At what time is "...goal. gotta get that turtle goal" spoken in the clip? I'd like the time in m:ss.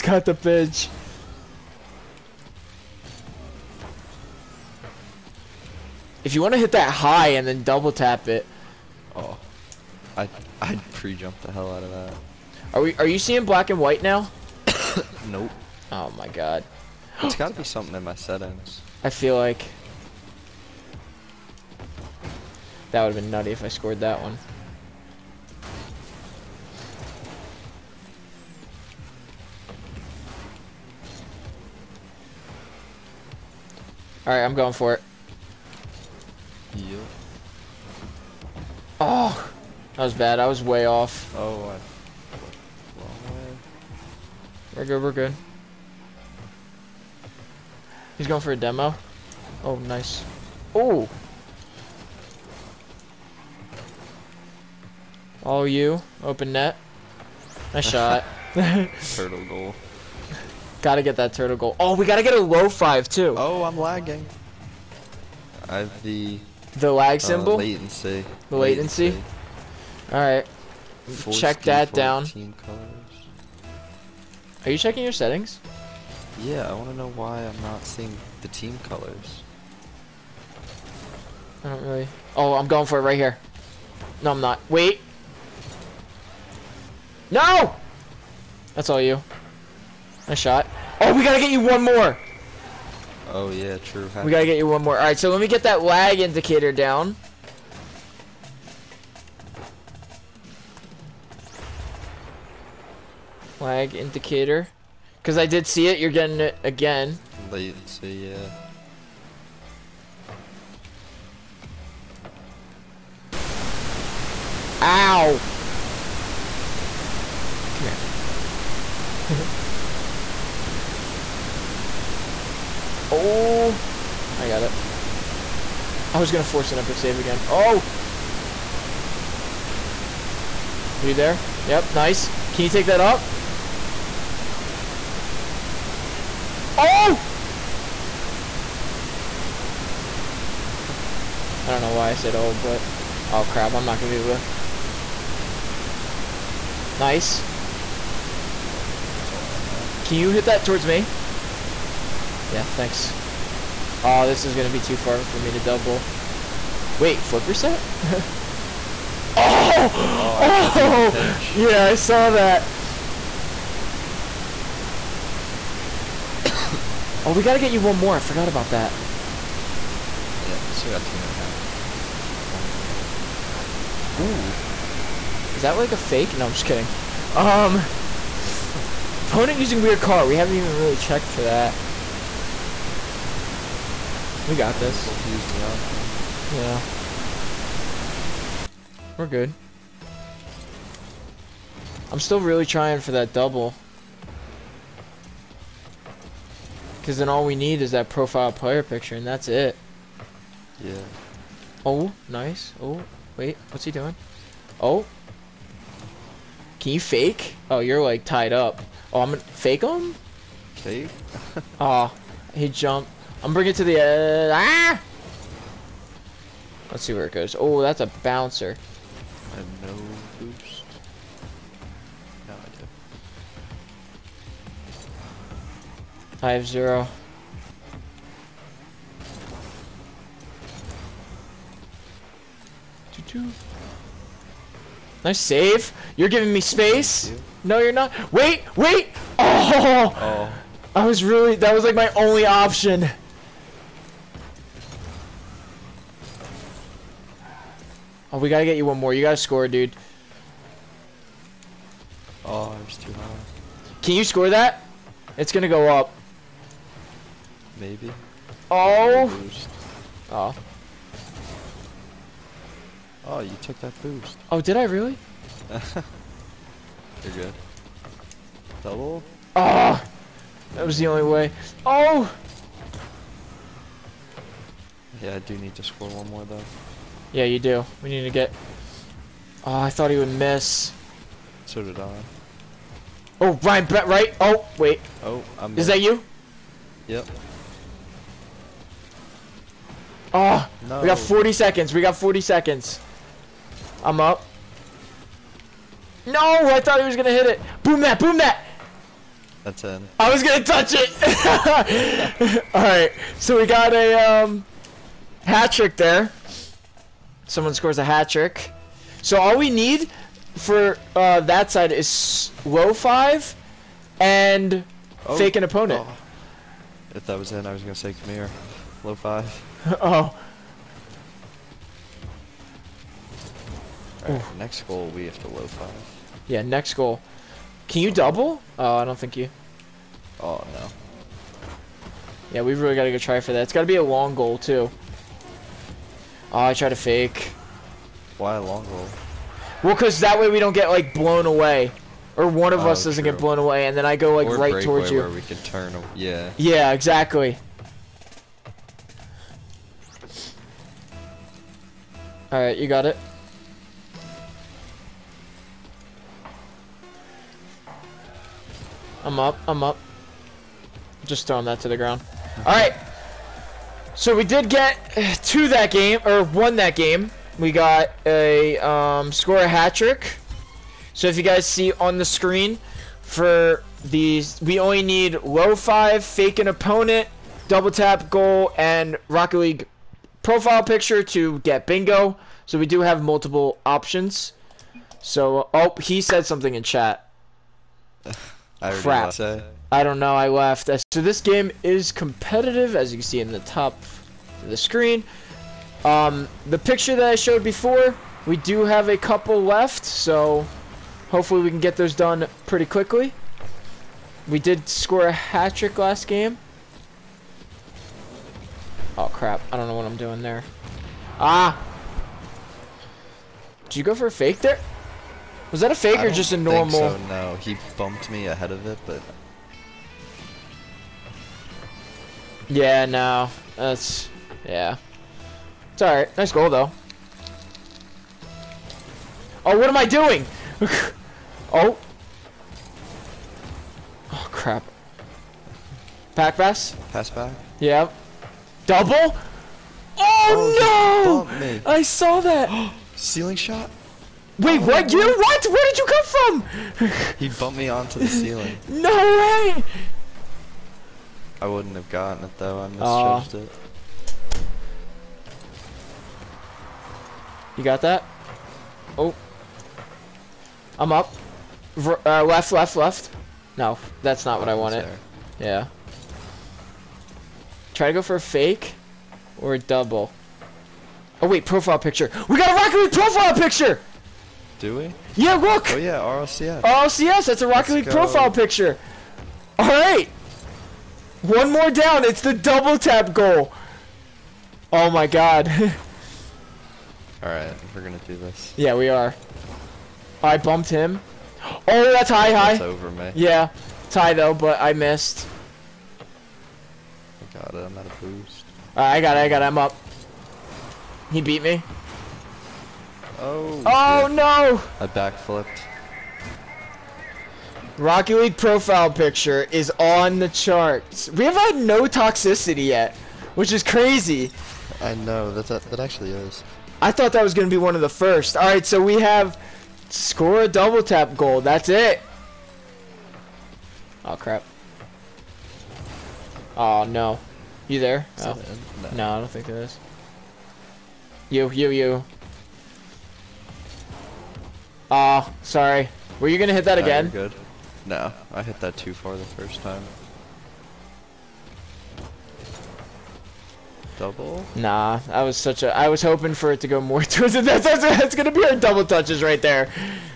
0:59.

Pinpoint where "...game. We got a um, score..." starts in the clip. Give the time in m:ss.
6:06.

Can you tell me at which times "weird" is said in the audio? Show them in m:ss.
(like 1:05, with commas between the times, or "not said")
2:59.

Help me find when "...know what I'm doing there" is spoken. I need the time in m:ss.
6:49.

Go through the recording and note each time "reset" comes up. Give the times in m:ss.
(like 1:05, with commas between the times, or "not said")
2:37.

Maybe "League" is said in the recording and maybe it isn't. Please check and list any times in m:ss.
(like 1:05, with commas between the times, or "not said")
6:19, 7:57, 8:28.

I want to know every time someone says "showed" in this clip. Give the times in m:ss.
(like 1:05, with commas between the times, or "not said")
6:37.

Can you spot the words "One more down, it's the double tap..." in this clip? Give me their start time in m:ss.
8:01.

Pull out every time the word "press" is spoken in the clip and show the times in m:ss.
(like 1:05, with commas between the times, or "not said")
not said.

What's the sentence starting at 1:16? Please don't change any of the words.
Yeah, I want to know why I'm not seeing the team colors.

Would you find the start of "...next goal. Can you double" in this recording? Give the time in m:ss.
5:26.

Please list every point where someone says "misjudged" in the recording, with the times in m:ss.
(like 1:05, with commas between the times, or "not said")
7:32.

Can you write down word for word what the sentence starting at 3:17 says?
Because then all we need is that profile player picture, and that's it.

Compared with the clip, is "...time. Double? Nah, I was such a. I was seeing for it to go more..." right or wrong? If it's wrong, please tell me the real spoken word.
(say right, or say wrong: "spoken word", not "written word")
wrong: "hoping", not "seeing".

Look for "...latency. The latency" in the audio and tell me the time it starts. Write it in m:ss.
1:07.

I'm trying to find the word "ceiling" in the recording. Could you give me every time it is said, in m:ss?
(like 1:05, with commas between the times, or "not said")
7:23, 7:28.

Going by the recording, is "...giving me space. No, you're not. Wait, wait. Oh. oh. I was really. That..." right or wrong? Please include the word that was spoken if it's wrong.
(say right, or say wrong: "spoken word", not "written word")
right.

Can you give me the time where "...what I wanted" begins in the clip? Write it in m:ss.
7:44.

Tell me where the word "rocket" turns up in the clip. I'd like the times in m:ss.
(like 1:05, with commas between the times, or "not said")
6:19, 7:52, 7:57, 8:27.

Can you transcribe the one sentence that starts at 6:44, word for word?
We did score a hat trick last game.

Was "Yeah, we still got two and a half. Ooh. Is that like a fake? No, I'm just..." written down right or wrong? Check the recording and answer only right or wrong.
right.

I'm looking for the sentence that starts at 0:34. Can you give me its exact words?
All right, I'm going for it.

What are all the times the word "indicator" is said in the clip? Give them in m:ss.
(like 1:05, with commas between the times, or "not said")
1:36, 1:43.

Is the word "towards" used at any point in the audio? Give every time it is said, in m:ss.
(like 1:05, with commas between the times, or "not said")
2:30, 5:44, 9:07.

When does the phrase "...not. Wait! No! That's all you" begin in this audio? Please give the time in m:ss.
1:24.